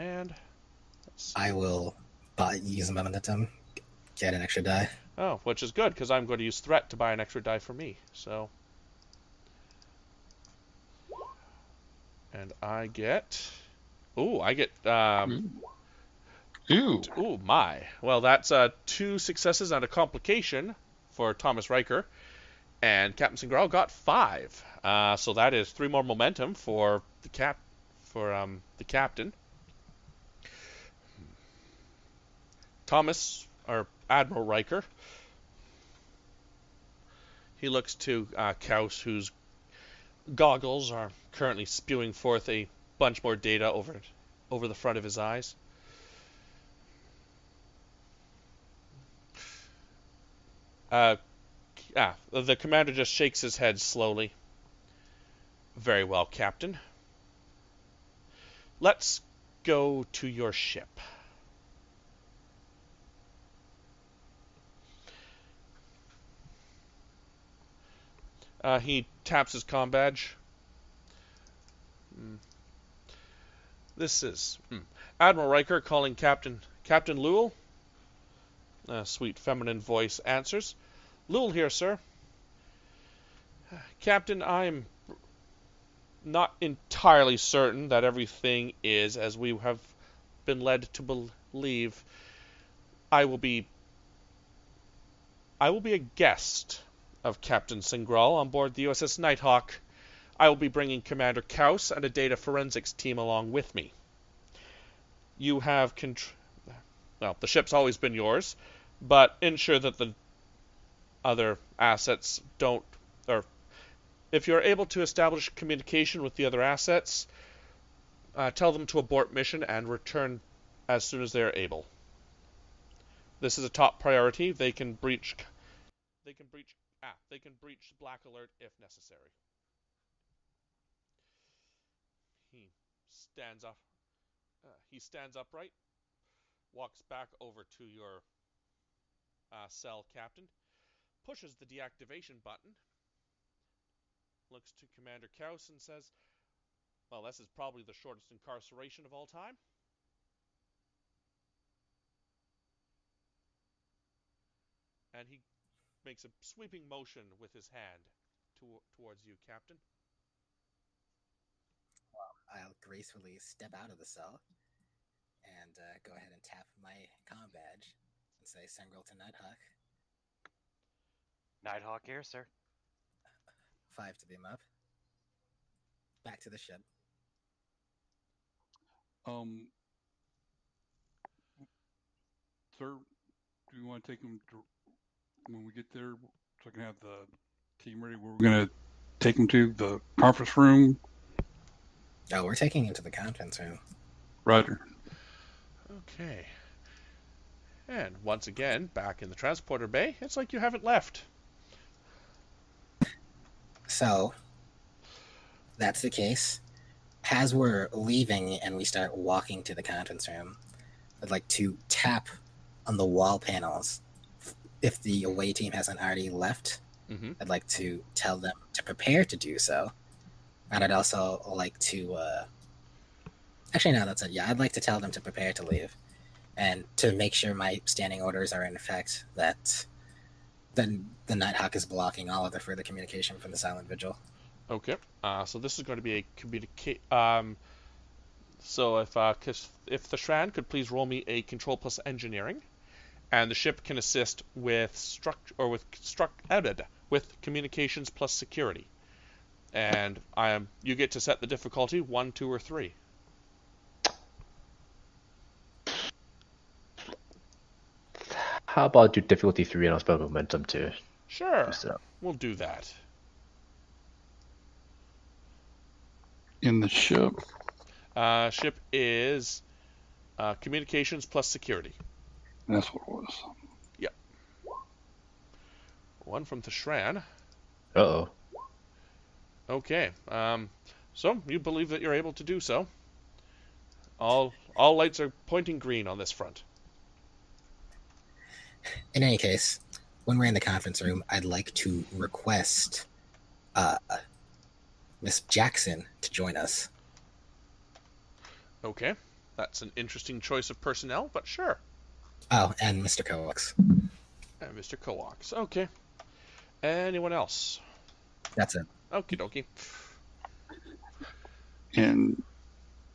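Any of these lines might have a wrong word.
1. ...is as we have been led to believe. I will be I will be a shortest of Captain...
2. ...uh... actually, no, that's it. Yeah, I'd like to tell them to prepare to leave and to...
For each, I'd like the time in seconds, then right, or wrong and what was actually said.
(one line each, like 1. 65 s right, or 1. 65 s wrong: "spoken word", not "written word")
1. 88 s wrong: "guest", not "shortest"
2. 222 s right.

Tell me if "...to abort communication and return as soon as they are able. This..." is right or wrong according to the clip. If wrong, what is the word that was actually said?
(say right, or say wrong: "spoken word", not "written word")
wrong: "mission", not "communication".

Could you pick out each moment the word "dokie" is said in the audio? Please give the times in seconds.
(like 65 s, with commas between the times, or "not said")
309 s.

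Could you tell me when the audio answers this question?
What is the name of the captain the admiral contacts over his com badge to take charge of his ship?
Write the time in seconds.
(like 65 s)
76 s.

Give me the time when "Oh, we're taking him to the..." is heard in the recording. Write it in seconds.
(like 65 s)
192 s.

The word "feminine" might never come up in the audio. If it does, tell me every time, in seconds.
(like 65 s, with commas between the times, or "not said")
79 s.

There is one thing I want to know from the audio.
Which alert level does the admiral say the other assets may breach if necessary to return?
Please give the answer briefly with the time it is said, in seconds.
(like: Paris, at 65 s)
Black Alert, at 127 s.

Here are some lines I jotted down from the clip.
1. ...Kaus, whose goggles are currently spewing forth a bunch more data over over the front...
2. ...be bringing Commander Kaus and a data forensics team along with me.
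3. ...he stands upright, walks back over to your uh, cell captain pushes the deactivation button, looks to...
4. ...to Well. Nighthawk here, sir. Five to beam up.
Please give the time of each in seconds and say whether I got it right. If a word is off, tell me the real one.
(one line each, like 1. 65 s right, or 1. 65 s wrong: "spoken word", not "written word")
1. 38 s right
2. 100 s right
3. 134 s right
4. 169 s wrong: "Nighthawk", not "Well".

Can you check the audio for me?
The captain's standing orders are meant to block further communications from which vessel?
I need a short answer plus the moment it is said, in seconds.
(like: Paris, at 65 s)
Silent Vigil, at 233 s.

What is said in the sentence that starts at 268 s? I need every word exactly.
Uh, ship is uh, communications plus security.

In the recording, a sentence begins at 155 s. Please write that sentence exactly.
And he makes a sweeping motion with his hand to towards you, Captain.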